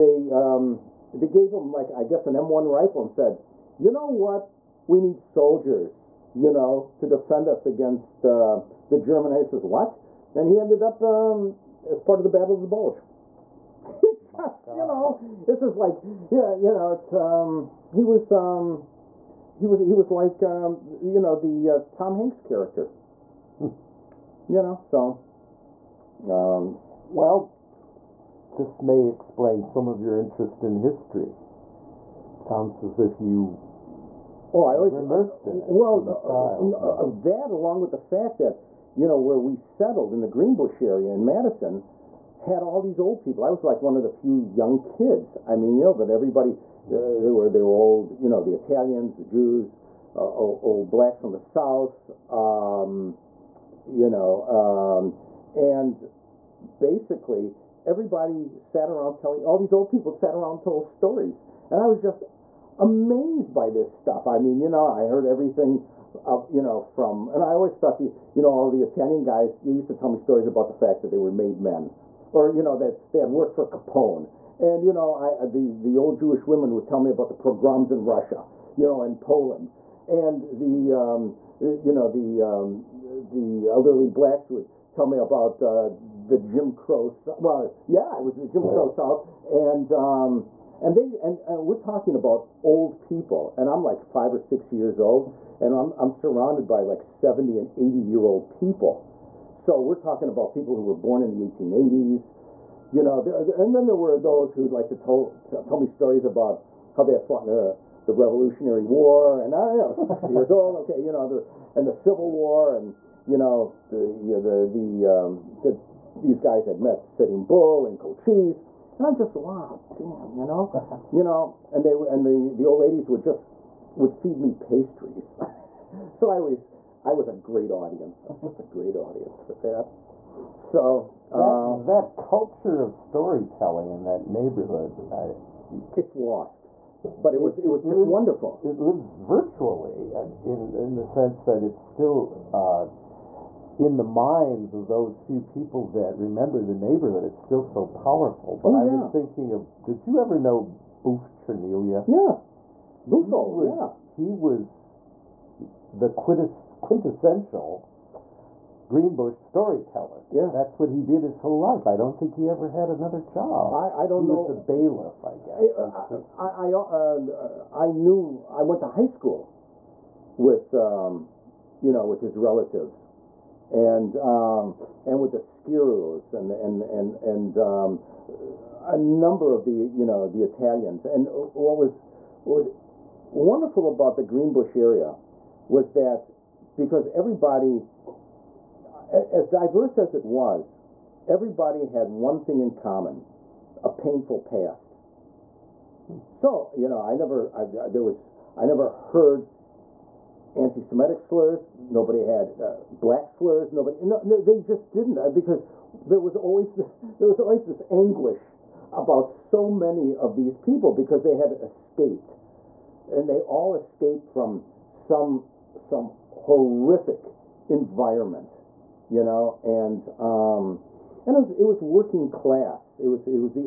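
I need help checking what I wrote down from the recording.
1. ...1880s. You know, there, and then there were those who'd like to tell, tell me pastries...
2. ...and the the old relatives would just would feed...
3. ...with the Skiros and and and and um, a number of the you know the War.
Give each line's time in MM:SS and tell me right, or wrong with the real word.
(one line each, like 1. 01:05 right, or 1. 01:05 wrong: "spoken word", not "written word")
1. 01:41 wrong: "stories", not "pastries"
2. 02:01 wrong: "ladies", not "relatives"
3. 02:55 wrong: "Italians", not "War".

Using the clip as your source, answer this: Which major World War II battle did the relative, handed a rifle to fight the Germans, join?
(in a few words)
Battle of the Bulge.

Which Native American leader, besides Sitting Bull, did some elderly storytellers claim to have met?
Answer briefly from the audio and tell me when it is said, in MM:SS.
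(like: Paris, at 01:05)
Cochise, at 01:57.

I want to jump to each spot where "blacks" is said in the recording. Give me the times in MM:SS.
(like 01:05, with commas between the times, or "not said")
00:50, 01:24, 03:22.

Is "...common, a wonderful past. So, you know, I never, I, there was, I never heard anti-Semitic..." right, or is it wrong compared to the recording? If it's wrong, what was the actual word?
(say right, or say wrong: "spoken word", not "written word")
wrong: "painful", not "wonderful".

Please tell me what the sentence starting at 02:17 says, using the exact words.
But it, it was it, was just lives, wonderful.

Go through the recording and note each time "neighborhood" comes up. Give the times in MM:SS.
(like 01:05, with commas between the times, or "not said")
02:14, 02:26.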